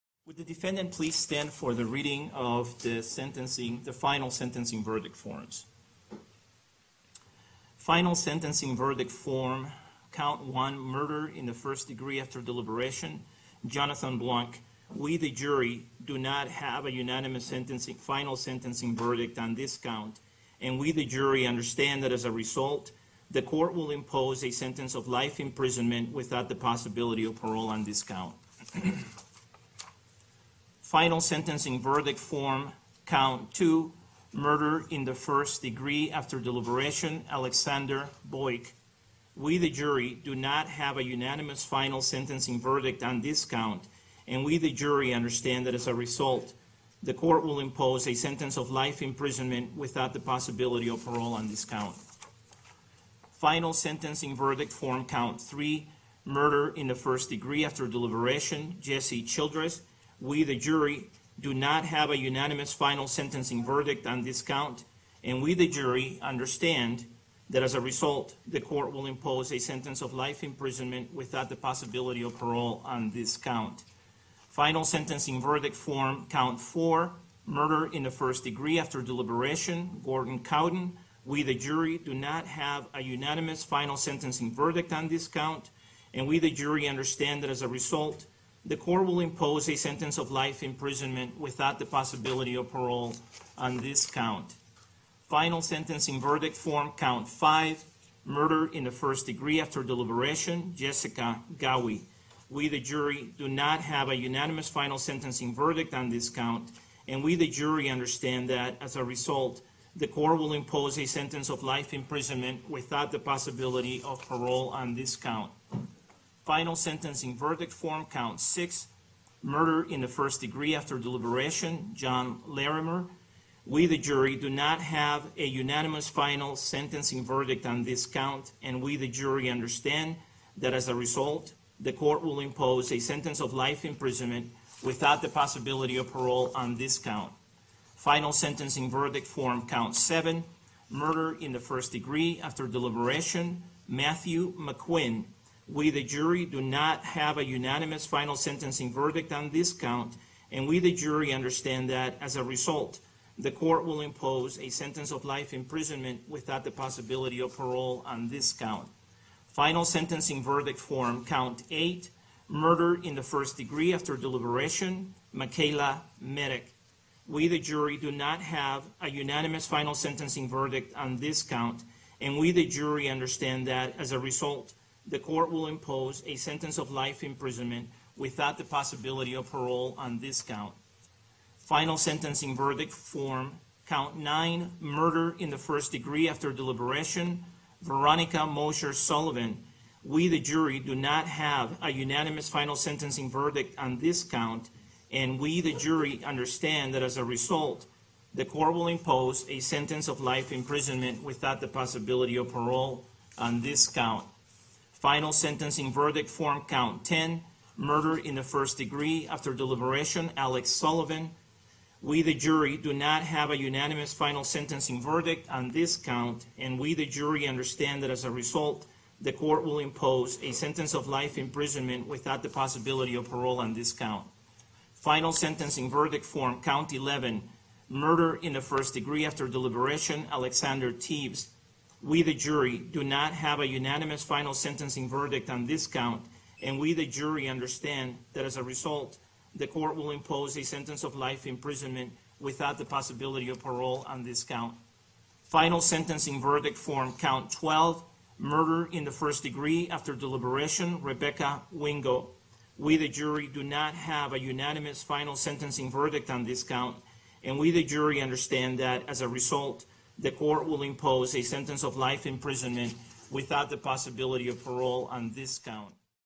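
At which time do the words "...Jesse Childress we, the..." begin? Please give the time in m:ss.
0:58.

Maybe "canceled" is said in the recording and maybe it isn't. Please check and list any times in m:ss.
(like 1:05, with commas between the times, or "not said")
not said.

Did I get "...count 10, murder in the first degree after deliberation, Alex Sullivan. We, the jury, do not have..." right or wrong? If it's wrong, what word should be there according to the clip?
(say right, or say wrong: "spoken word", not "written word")
right.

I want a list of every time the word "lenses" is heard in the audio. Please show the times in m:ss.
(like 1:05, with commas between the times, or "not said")
not said.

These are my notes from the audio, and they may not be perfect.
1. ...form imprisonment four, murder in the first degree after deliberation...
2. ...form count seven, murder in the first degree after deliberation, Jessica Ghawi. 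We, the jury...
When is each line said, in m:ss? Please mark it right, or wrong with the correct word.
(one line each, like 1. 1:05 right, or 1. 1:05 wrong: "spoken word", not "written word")
1. 1:15 wrong: "count", not "imprisonment"
2. 1:36 wrong: "five", not "seven".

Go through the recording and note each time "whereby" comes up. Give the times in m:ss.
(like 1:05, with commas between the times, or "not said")
not said.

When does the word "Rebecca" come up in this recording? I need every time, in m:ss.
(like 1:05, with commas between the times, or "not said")
4:11.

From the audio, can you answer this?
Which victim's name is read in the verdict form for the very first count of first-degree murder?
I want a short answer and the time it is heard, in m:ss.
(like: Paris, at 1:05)
Jonathan Blanc, at 0:13.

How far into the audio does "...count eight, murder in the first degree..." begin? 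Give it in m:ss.
2:41.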